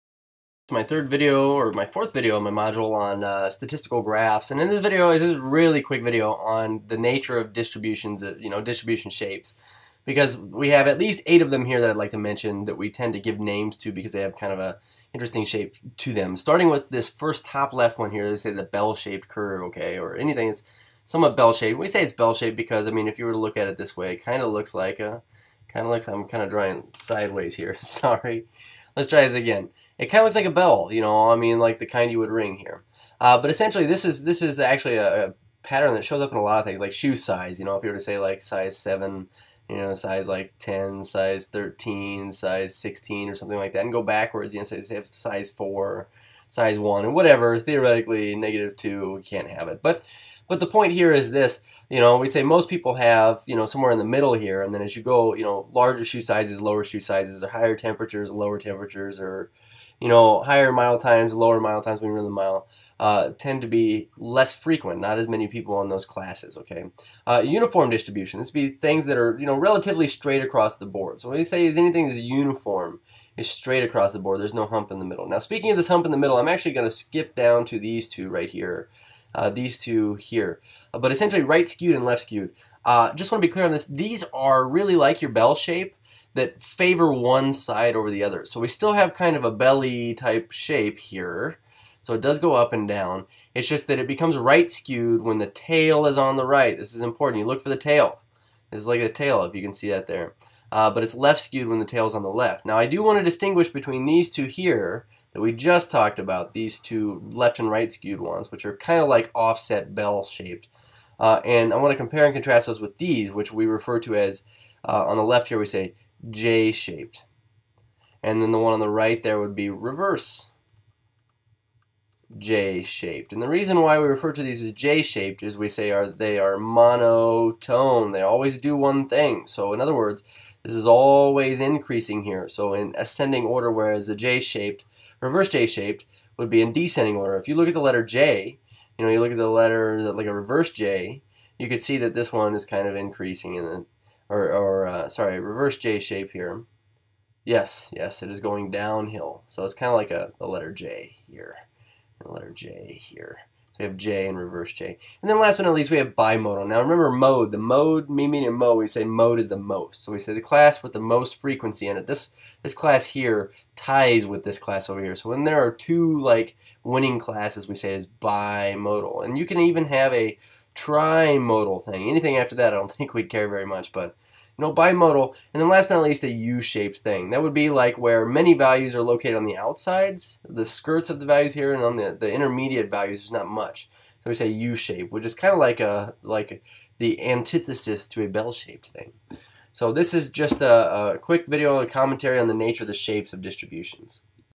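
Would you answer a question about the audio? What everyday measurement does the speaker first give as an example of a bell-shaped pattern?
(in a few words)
Shoe size.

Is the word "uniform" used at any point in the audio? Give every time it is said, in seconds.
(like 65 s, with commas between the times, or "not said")
67 s, 72 s.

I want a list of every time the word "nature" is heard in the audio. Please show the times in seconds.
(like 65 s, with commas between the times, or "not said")
6 s, 192 s.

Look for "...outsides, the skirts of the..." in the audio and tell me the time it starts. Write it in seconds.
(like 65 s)
179 s.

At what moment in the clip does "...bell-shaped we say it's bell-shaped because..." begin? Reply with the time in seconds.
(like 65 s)
21 s.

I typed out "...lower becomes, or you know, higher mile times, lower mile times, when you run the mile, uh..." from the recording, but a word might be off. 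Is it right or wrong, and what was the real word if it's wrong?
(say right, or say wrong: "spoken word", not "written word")
wrong: "temperatures", not "becomes".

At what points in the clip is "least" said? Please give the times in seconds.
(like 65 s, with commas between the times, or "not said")
10 s, 155 s, 176 s.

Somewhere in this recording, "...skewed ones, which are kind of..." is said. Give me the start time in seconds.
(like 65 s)
107 s.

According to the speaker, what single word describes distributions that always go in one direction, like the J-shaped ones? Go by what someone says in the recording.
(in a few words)
Monotone.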